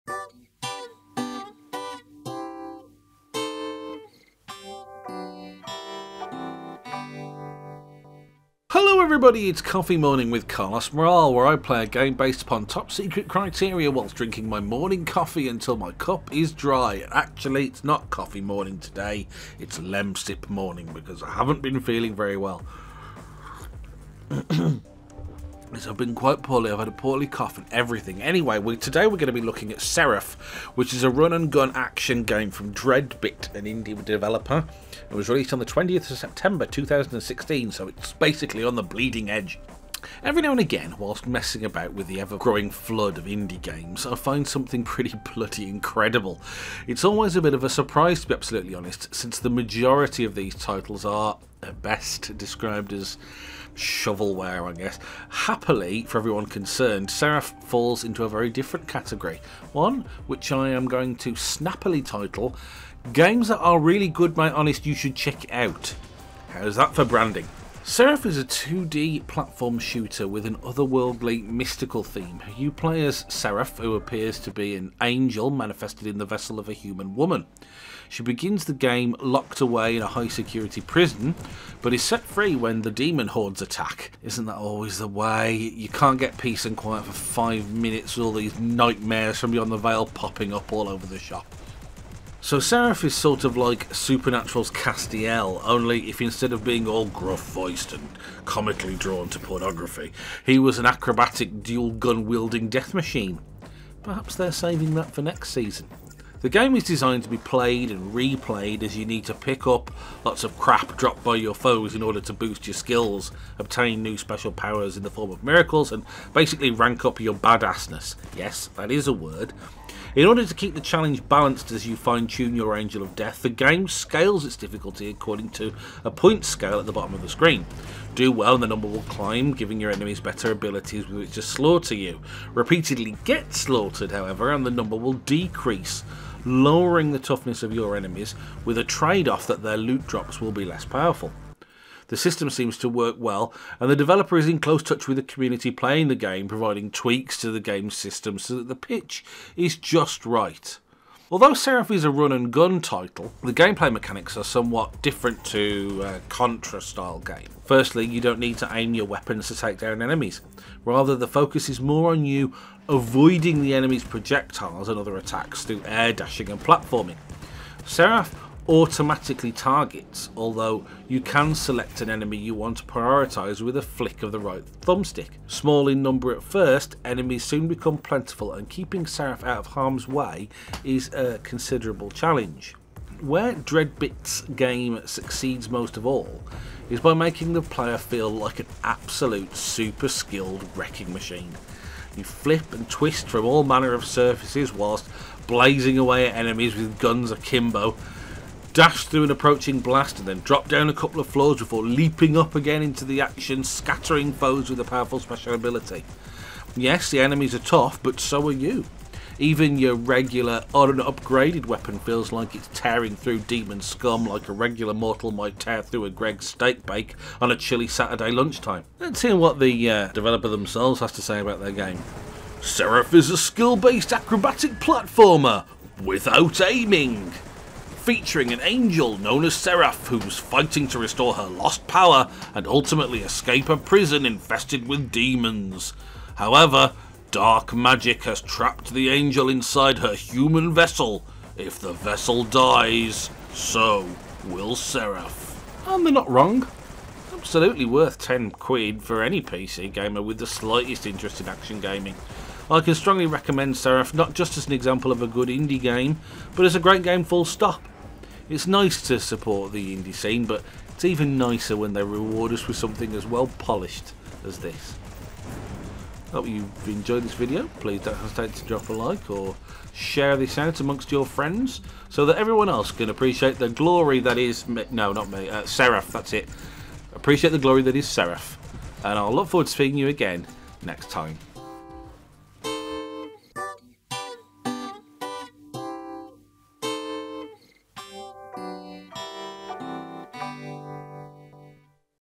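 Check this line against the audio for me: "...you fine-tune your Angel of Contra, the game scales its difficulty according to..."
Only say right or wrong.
wrong.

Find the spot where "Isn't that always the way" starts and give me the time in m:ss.
1:24.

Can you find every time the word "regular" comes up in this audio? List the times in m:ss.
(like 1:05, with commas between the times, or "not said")
3:29, 3:34.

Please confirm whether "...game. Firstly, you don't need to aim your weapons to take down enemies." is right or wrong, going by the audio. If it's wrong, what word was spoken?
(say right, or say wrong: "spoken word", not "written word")
right.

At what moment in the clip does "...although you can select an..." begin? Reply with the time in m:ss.
2:50.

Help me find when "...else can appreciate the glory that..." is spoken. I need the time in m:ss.
4:32.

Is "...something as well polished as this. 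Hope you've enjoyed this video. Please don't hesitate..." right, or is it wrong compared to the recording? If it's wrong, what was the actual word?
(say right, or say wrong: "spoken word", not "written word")
right.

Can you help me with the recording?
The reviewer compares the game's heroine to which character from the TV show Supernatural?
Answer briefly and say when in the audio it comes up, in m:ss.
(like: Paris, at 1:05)
Castiel, at 1:34.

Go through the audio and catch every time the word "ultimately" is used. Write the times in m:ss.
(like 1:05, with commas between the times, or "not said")
3:52.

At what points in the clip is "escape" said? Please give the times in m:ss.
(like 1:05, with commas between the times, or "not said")
3:53.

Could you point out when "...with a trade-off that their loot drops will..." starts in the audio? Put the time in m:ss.
2:18.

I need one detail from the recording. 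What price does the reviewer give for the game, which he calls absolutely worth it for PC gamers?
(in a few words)
10 quid.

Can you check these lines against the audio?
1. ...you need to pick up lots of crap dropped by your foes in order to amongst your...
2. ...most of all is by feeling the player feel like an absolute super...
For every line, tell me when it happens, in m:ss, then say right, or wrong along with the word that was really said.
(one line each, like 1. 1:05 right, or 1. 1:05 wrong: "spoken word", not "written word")
1. 1:48 wrong: "boost", not "amongst"
2. 3:05 wrong: "making", not "feeling".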